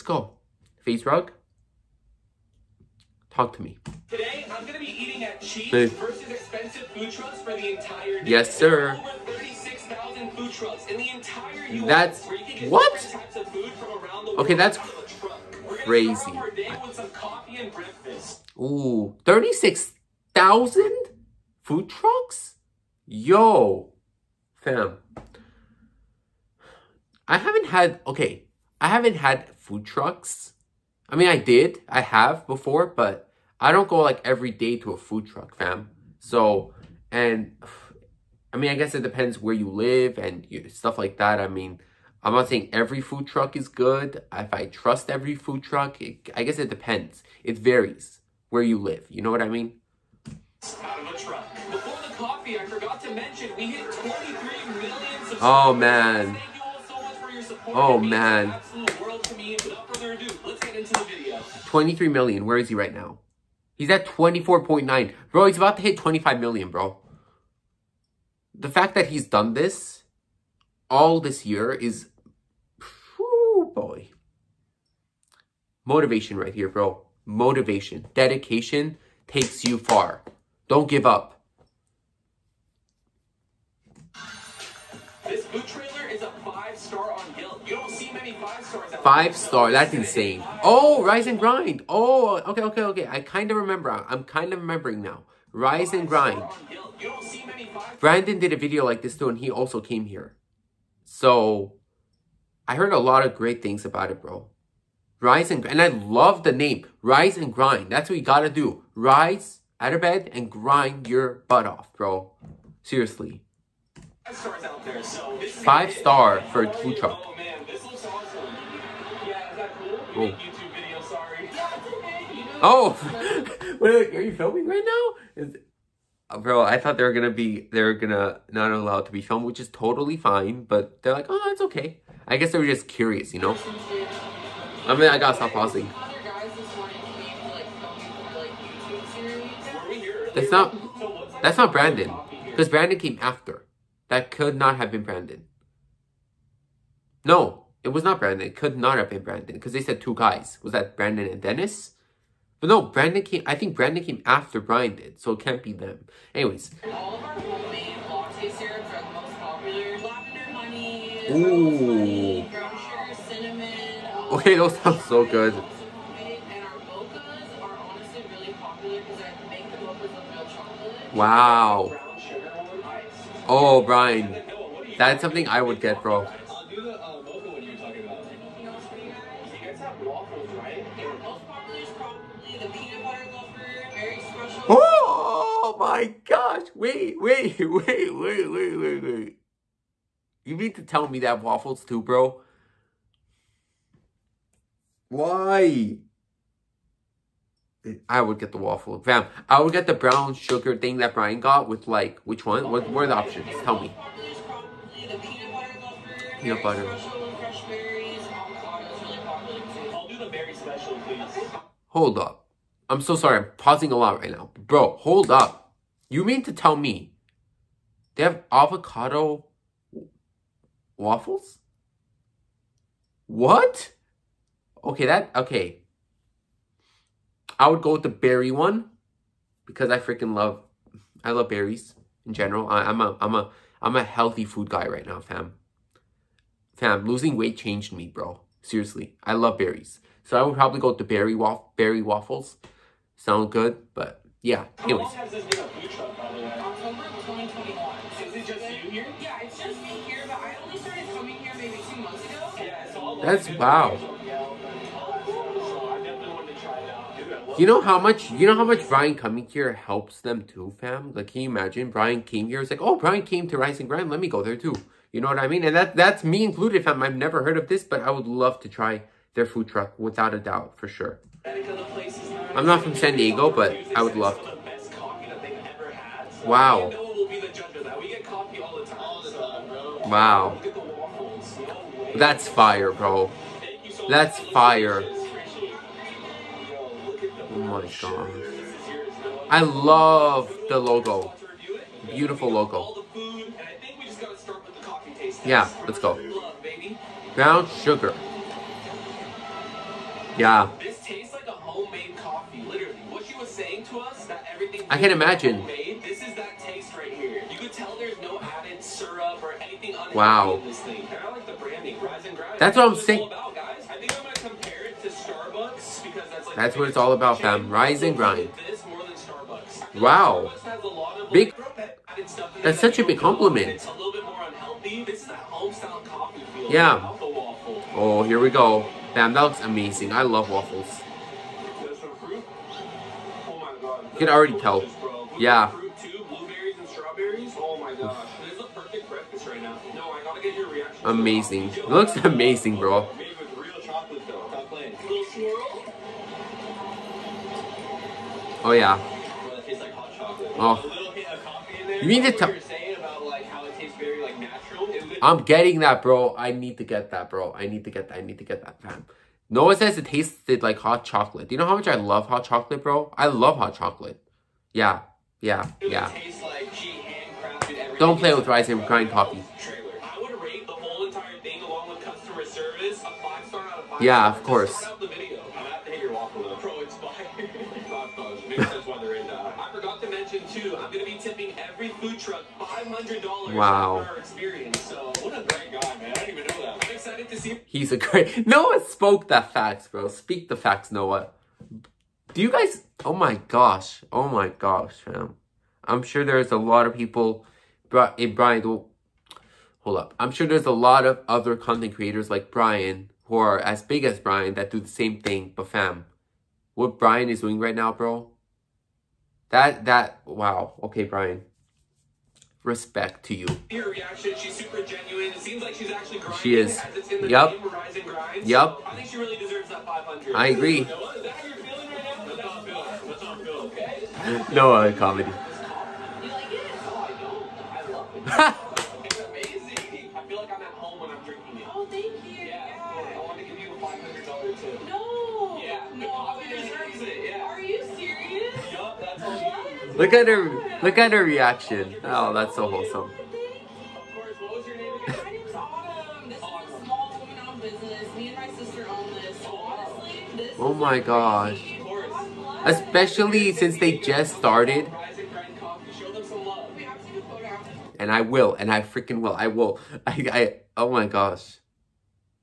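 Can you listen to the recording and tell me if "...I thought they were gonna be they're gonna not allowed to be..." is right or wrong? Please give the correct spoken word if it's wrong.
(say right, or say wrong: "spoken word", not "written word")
right.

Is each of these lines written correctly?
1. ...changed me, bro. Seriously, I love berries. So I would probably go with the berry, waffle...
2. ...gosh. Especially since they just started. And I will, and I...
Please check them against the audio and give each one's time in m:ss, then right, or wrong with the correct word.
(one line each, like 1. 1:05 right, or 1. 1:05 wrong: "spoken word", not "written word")
1. 3:57 right
2. 7:30 right.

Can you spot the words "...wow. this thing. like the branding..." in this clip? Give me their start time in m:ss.
5:10.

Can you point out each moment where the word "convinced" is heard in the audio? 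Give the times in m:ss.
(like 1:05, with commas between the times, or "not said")
not said.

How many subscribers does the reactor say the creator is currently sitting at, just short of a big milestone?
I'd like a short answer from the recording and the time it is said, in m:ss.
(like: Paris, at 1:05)
24.9 million, at 1:04.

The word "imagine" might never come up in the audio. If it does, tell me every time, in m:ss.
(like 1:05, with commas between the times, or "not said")
4:21, 5:05.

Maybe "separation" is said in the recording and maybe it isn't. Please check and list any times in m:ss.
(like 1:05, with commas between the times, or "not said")
not said.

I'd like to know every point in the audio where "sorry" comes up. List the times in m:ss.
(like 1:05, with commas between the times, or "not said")
3:33.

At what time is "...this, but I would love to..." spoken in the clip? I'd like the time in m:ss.
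4:27.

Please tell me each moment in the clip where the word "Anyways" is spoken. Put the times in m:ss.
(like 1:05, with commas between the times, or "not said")
2:36, 4:04.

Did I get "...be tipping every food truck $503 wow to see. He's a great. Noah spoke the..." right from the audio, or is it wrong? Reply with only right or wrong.
wrong.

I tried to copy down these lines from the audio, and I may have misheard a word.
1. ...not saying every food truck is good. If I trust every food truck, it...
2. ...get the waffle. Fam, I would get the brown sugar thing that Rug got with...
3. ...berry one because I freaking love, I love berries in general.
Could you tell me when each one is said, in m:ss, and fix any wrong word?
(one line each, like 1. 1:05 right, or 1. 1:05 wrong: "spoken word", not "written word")
1. 0:42 right
2. 3:18 wrong: "Brian", not "Rug"
3. 3:48 right.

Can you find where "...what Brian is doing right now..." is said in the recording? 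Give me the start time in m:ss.
6:46.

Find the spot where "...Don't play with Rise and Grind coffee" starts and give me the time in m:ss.
6:07.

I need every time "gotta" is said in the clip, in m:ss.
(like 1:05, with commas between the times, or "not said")
1:48, 2:15.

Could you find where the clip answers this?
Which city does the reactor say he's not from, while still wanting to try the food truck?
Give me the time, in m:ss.
4:32.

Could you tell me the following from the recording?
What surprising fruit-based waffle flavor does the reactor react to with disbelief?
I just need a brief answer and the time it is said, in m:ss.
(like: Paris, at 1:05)
Avocado, at 3:38.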